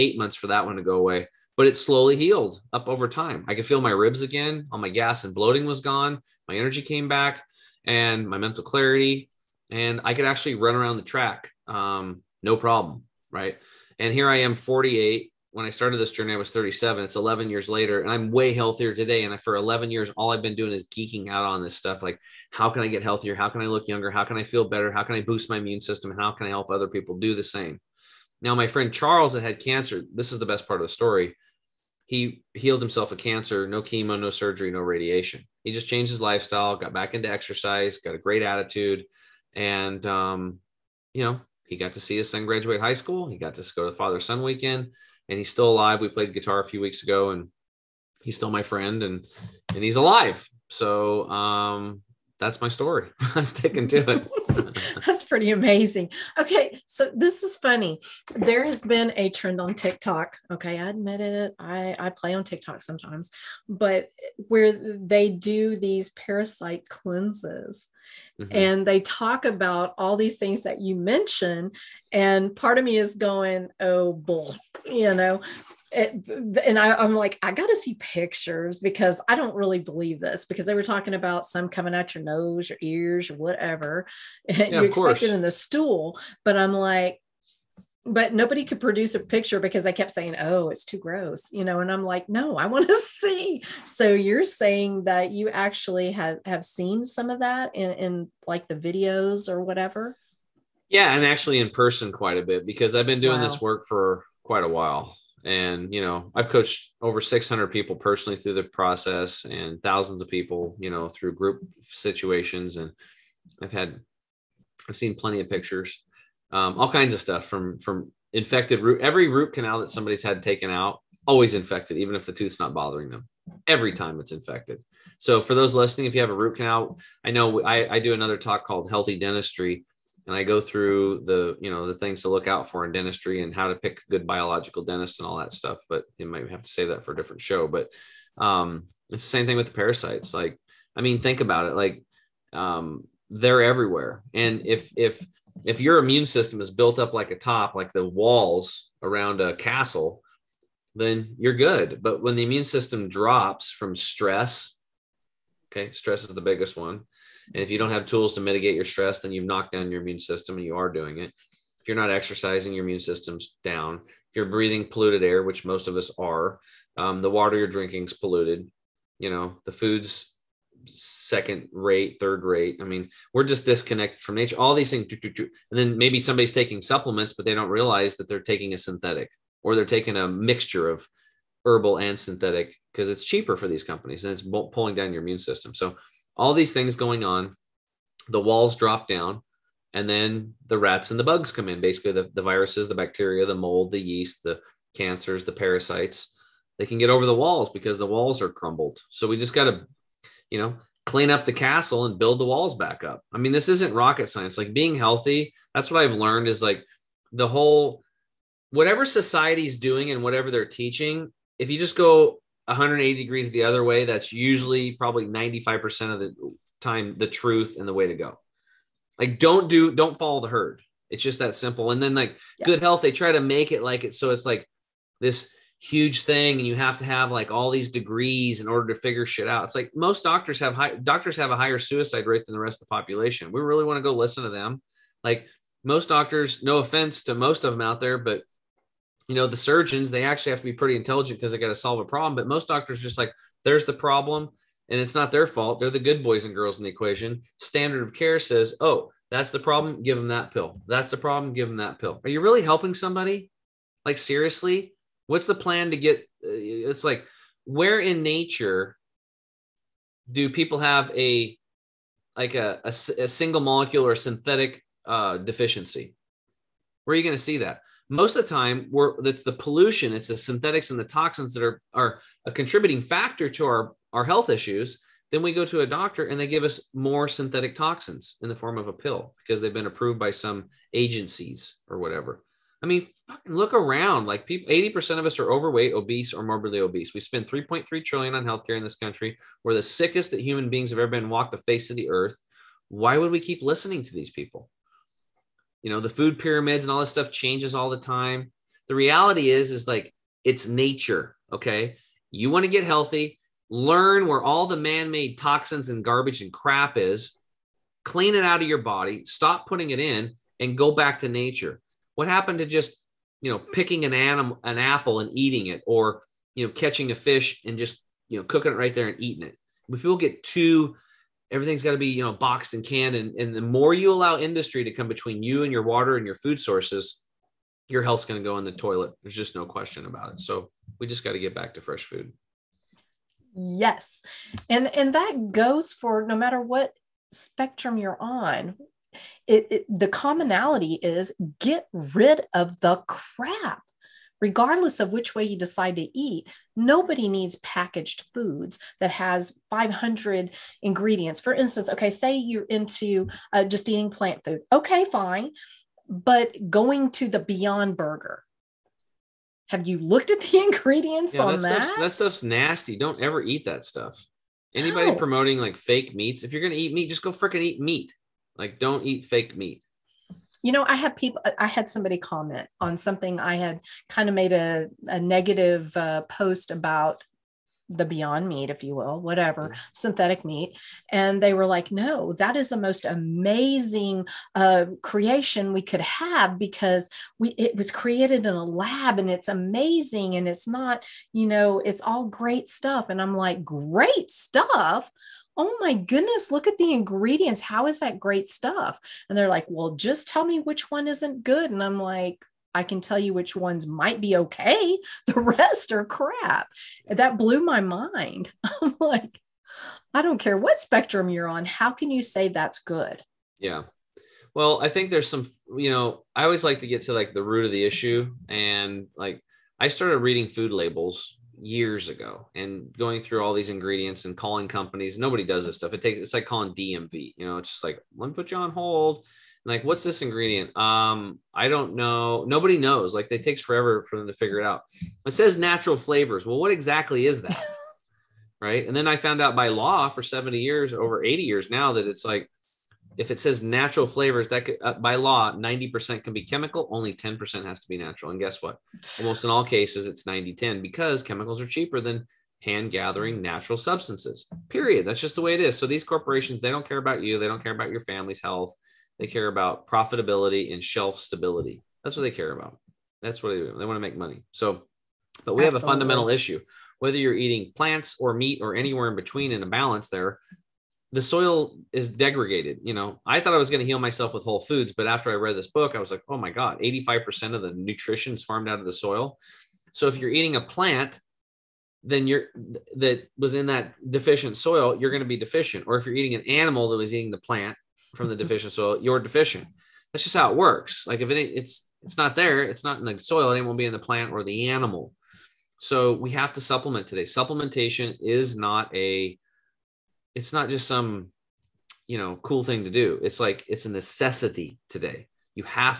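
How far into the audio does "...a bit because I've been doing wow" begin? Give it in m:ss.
1:42.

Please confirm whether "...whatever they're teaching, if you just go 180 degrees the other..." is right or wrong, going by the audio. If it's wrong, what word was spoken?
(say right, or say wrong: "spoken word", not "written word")
right.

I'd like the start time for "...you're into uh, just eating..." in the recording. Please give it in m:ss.
5:52.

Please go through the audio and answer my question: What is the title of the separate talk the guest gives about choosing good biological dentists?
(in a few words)
Healthy Dentistry.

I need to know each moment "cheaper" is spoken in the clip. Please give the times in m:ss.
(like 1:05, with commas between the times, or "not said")
3:03, 7:31.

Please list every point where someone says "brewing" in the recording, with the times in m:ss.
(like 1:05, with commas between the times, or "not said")
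not said.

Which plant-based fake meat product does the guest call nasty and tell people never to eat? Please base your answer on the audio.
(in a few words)
Beyond Burger.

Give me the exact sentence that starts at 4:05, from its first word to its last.
They're the good boys and girls in the equation.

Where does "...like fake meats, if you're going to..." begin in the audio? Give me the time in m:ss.
6:05.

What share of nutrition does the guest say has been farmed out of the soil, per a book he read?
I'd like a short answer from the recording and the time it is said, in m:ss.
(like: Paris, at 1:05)
85%, at 7:56.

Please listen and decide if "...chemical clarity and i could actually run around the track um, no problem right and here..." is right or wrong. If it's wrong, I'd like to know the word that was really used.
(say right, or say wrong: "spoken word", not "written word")
wrong: "mental", not "chemical".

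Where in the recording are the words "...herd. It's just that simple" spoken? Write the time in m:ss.
3:40.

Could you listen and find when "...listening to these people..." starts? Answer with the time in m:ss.
4:53.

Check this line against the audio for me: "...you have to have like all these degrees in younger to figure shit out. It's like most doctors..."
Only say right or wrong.
wrong.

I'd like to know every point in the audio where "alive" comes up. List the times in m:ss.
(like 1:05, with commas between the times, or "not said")
0:45, 0:49.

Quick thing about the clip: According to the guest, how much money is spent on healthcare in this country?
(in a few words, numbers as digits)
3.3 trillion.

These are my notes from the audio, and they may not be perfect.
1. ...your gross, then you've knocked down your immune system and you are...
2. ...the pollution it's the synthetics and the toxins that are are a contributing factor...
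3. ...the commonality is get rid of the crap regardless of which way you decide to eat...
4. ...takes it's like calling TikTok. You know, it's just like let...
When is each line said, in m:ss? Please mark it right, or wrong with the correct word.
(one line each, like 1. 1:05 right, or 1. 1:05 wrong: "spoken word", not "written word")
1. 2:38 wrong: "stress", not "gross"
2. 4:29 right
3. 5:39 right
4. 7:06 wrong: "DMV", not "TikTok".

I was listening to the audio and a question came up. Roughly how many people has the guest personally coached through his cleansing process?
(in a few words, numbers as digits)
over 600.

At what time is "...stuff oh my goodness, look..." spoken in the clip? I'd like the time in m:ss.
6:34.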